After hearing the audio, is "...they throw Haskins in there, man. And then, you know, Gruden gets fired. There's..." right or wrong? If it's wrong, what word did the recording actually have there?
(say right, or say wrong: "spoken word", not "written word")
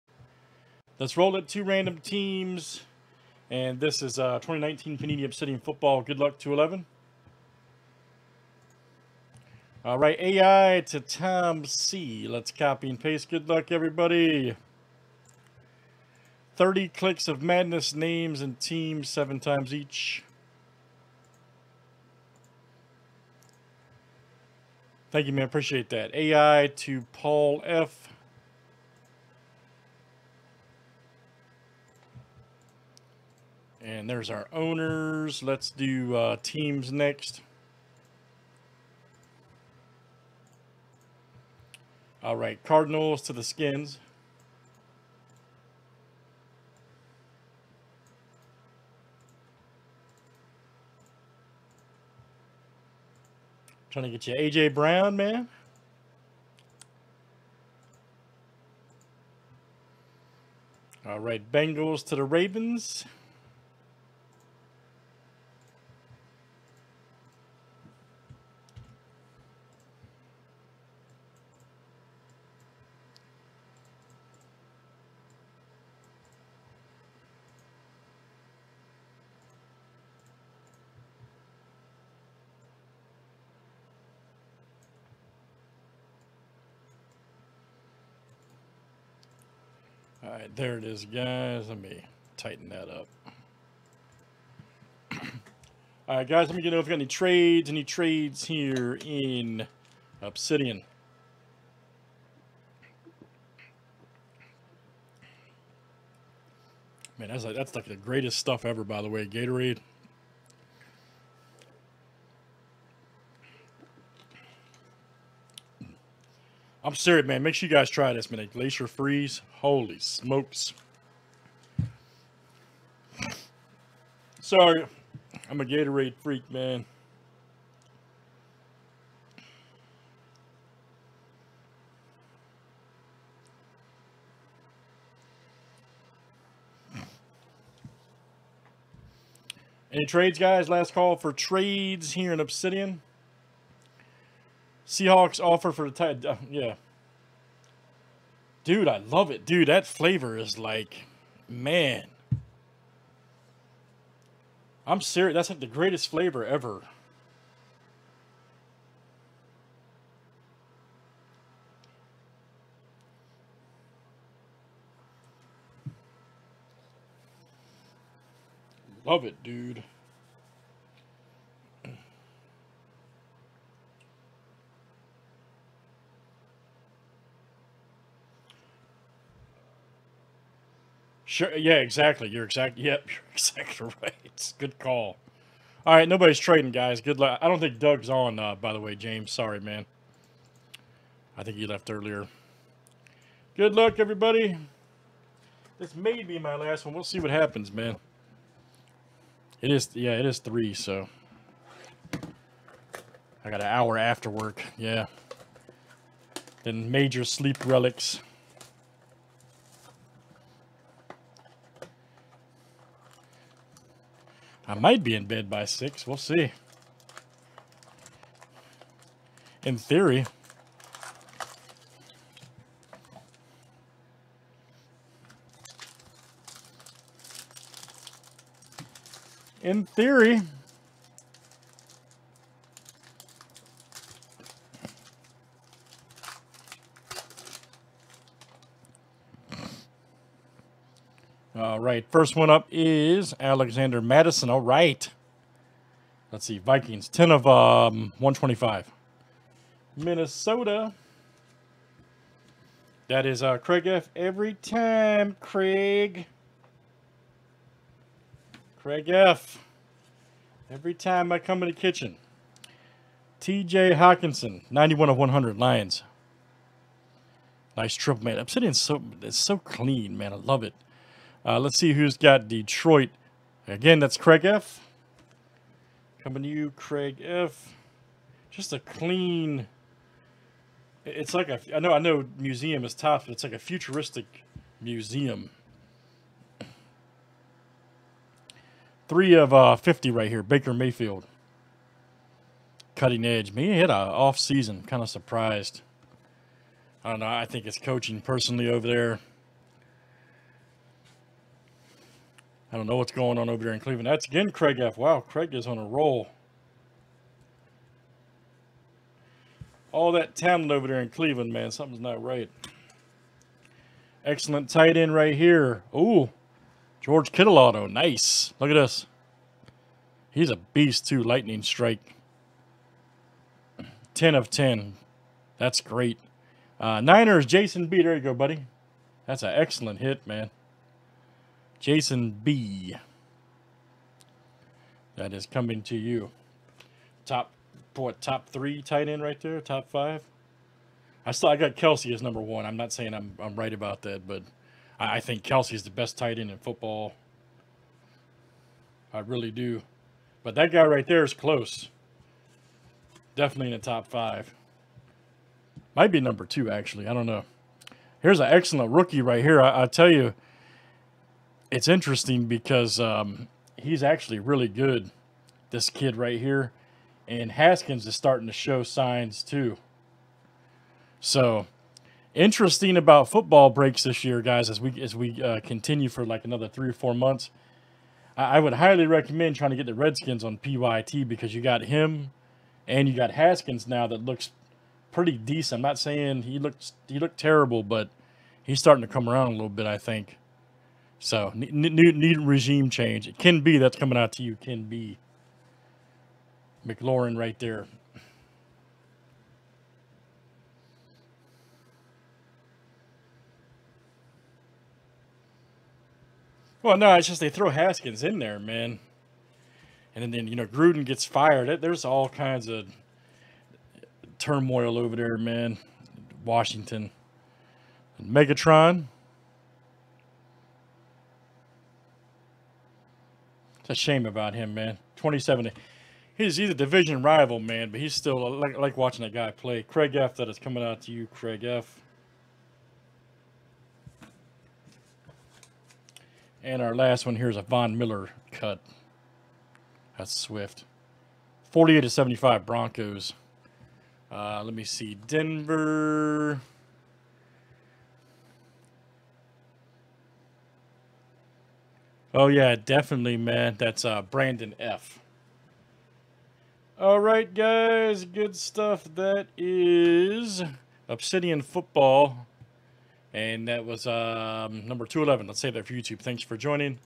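right.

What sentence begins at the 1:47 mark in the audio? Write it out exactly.
Man, that's like, that's like the greatest stuff ever, by the way.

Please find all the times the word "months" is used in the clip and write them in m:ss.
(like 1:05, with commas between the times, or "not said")
6:17.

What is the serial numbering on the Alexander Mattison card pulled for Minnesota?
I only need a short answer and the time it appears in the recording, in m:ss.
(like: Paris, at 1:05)
10 of 125, at 4:07.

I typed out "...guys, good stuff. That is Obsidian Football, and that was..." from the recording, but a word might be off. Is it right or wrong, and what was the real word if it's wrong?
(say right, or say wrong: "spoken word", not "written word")
right.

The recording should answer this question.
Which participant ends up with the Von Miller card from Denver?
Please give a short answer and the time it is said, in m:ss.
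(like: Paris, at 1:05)
Brandon F., at 7:34.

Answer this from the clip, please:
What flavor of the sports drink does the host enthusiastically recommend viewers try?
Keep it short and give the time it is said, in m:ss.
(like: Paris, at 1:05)
Glacier Freeze, at 1:58.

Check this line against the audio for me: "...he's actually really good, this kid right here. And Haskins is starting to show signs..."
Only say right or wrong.
right.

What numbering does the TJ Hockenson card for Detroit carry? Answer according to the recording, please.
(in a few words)
91 of 100.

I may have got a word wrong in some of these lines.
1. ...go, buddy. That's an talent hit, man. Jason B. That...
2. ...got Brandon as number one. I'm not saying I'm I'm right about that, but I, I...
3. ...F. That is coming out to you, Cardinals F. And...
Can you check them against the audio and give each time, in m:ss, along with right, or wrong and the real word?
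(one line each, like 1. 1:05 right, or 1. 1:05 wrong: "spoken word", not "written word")
1. 5:28 wrong: "excellent", not "talent"
2. 5:41 wrong: "Kelce", not "Brandon"
3. 7:10 wrong: "Craig", not "Cardinals".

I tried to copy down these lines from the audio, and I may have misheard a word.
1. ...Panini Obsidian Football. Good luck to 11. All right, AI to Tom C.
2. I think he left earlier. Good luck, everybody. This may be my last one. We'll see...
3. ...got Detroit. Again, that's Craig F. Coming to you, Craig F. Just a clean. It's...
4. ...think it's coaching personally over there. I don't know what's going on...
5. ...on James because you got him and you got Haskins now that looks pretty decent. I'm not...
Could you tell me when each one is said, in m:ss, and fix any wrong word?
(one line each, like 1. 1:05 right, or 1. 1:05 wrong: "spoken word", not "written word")
1. 0:04 right
2. 3:11 right
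3. 4:32 right
4. 4:57 right
5. 6:20 wrong: "PYT", not "James".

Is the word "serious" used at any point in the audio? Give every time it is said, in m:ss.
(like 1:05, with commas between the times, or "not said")
1:56, 2:34.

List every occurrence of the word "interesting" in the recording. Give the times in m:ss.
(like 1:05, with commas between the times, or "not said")
6:01, 6:12.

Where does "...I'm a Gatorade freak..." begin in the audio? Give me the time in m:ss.
2:05.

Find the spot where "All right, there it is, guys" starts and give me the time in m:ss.
1:30.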